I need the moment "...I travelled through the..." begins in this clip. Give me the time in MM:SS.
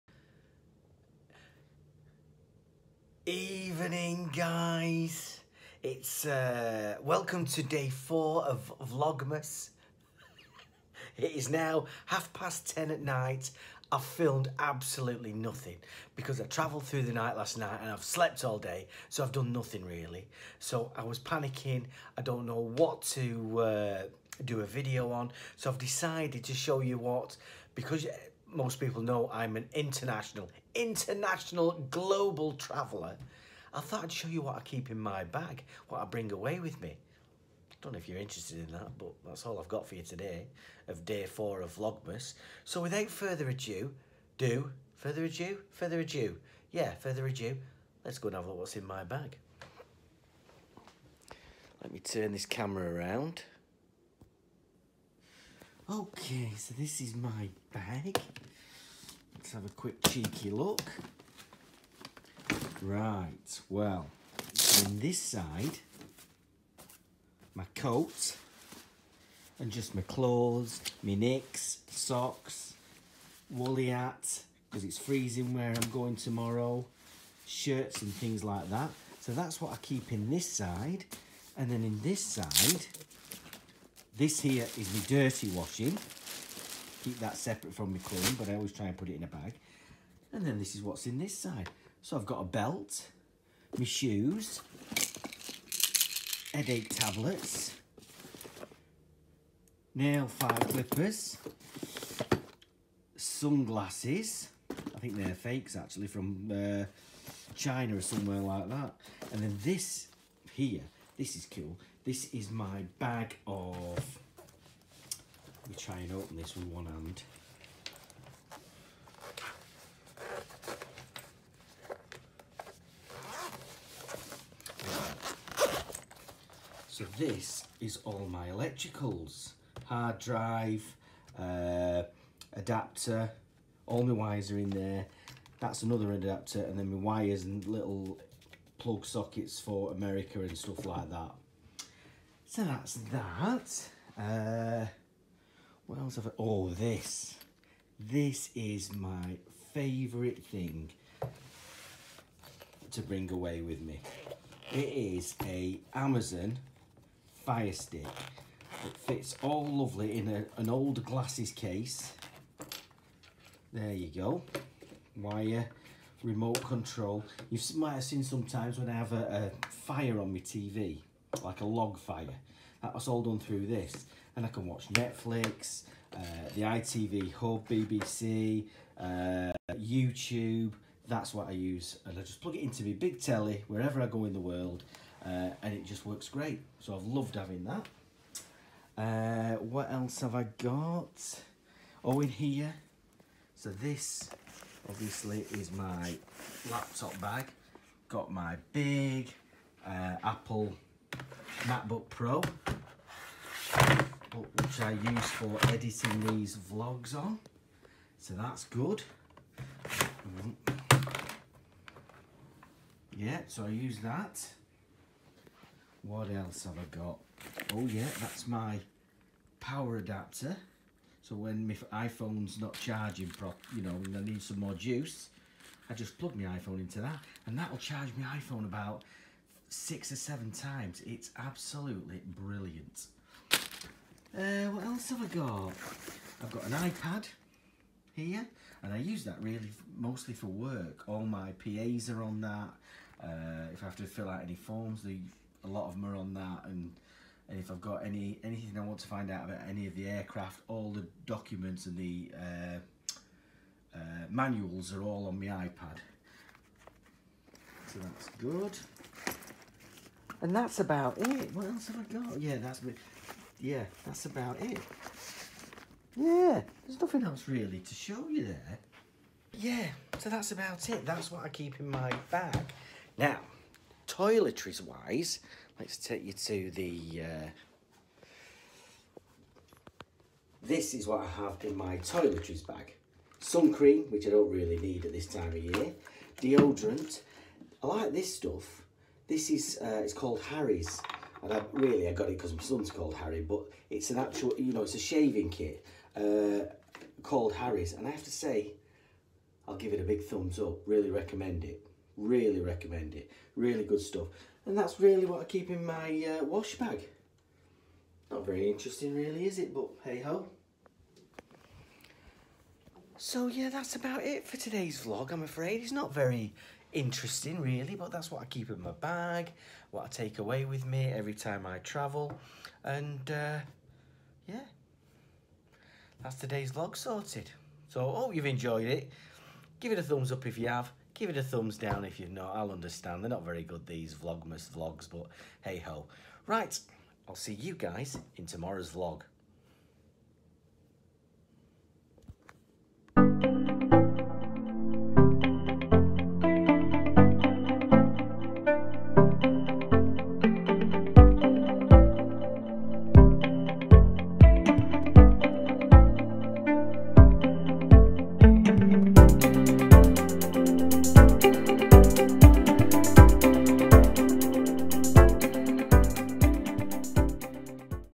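00:16.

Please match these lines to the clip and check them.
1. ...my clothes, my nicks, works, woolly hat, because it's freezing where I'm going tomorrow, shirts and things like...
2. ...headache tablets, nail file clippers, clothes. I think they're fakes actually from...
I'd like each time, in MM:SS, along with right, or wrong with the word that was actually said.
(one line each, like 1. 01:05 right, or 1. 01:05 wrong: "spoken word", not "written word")
1. 01:09 wrong: "socks", not "works"
2. 01:36 wrong: "sunglasses", not "clothes".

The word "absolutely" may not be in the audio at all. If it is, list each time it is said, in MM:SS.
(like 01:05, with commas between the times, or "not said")
00:14, 03:51.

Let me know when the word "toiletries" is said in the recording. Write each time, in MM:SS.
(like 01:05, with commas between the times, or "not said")
04:34, 04:41.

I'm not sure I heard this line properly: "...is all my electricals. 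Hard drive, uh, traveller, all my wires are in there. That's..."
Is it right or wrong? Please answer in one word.
wrong.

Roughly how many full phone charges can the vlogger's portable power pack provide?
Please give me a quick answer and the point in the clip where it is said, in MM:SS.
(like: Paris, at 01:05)
6 or 7, at 03:49.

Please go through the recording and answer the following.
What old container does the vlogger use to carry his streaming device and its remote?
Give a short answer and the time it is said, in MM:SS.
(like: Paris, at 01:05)
Glasses case, at 02:40.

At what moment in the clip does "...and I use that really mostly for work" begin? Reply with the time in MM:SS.
03:58.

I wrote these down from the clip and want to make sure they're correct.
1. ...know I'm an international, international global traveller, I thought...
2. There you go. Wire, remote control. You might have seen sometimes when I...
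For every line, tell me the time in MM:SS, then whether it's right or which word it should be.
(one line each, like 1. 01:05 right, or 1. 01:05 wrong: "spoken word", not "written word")
1. 00:29 right
2. 02:43 right.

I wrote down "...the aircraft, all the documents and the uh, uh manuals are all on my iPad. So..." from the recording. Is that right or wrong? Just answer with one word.
right.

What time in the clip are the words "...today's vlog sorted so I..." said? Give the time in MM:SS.
05:26.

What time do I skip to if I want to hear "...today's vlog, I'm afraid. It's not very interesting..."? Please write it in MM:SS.
05:14.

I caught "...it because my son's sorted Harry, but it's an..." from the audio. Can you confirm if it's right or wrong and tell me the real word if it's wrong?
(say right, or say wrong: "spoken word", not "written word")
wrong: "called", not "sorted".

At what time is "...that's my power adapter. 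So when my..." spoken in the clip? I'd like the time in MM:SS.
03:38.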